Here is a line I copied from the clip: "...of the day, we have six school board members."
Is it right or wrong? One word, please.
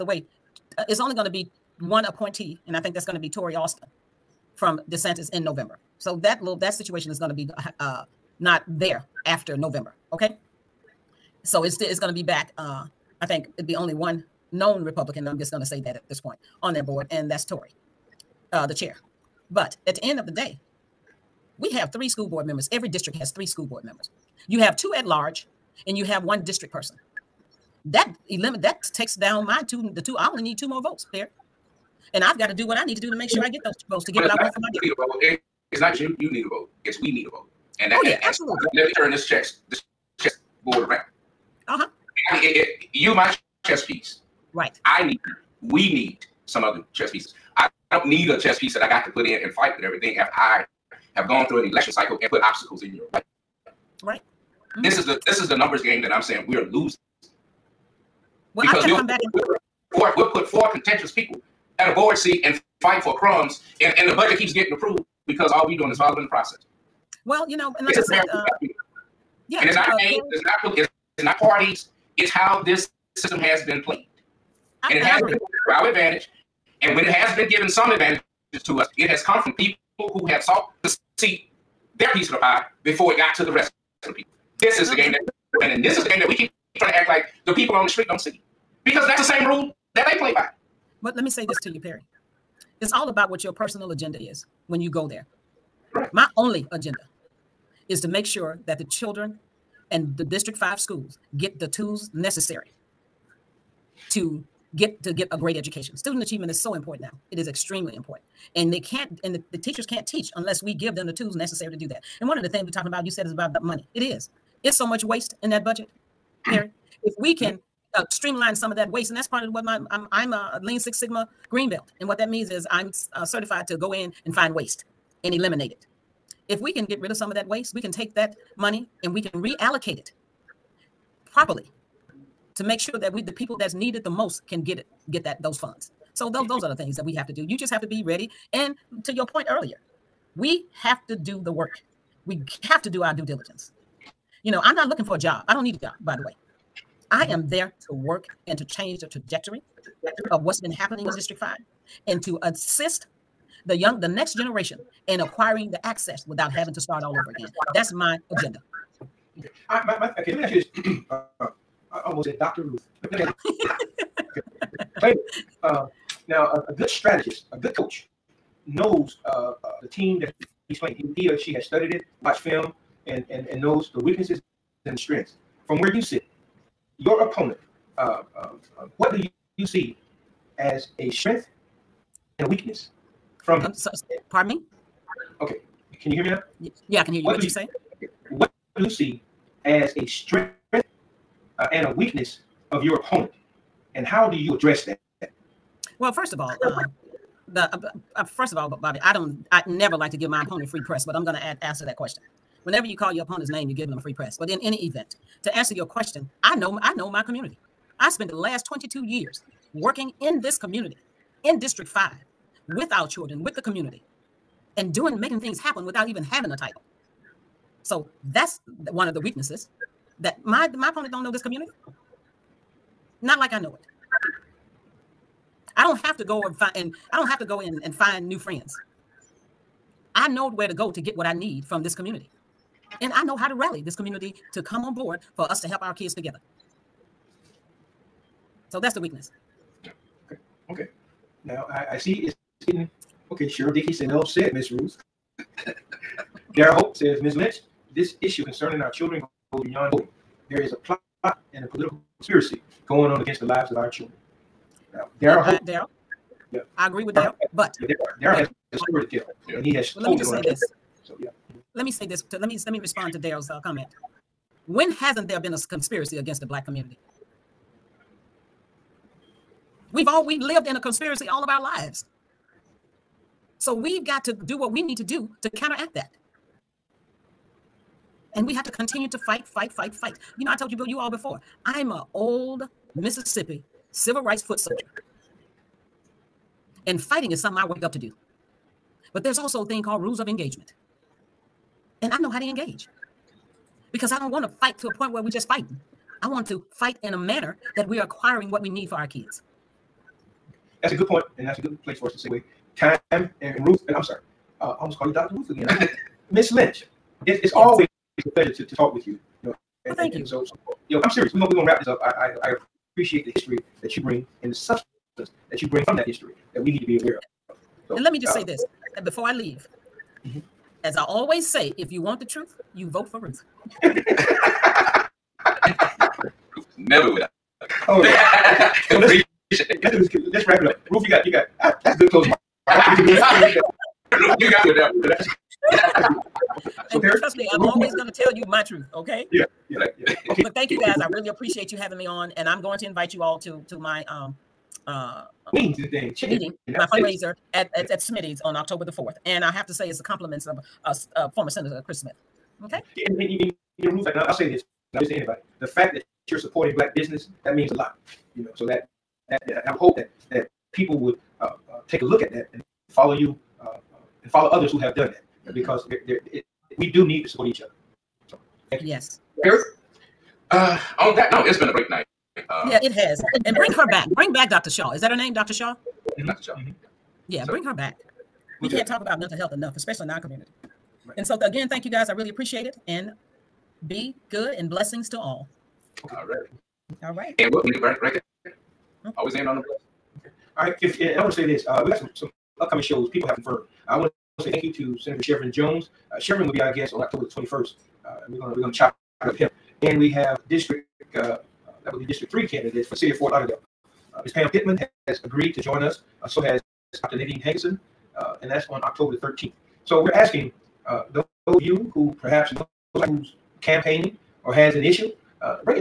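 wrong.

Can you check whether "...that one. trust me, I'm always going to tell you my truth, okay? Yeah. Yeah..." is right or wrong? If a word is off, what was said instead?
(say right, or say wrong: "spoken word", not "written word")
right.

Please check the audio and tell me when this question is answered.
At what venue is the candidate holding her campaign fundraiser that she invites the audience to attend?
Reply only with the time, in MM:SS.
05:47.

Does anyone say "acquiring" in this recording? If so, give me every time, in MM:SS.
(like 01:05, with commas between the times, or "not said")
02:35, 04:58.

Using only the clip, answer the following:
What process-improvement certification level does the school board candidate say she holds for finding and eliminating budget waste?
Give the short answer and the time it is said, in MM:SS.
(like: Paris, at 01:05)
Lean Six Sigma green belt, at 02:00.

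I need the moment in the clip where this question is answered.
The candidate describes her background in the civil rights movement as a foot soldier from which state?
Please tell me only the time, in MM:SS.
04:42.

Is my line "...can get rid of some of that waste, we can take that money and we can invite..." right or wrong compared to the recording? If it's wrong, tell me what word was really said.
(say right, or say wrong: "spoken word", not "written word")
wrong: "reallocate", not "invite".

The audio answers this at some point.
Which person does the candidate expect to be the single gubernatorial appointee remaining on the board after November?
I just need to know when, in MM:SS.
00:03.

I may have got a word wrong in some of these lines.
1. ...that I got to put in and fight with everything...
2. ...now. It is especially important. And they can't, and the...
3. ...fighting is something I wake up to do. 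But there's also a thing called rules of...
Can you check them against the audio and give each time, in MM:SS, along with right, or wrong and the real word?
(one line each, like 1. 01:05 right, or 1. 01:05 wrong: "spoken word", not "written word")
1. 00:48 right
2. 01:47 wrong: "extremely", not "especially"
3. 04:47 right.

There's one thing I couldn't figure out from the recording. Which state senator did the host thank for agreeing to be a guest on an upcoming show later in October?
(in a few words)
Shevrin Jones.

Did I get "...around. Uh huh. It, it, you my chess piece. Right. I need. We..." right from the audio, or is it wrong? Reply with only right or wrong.
right.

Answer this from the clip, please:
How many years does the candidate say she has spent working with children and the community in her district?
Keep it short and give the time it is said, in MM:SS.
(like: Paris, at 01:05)
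22, at 03:28.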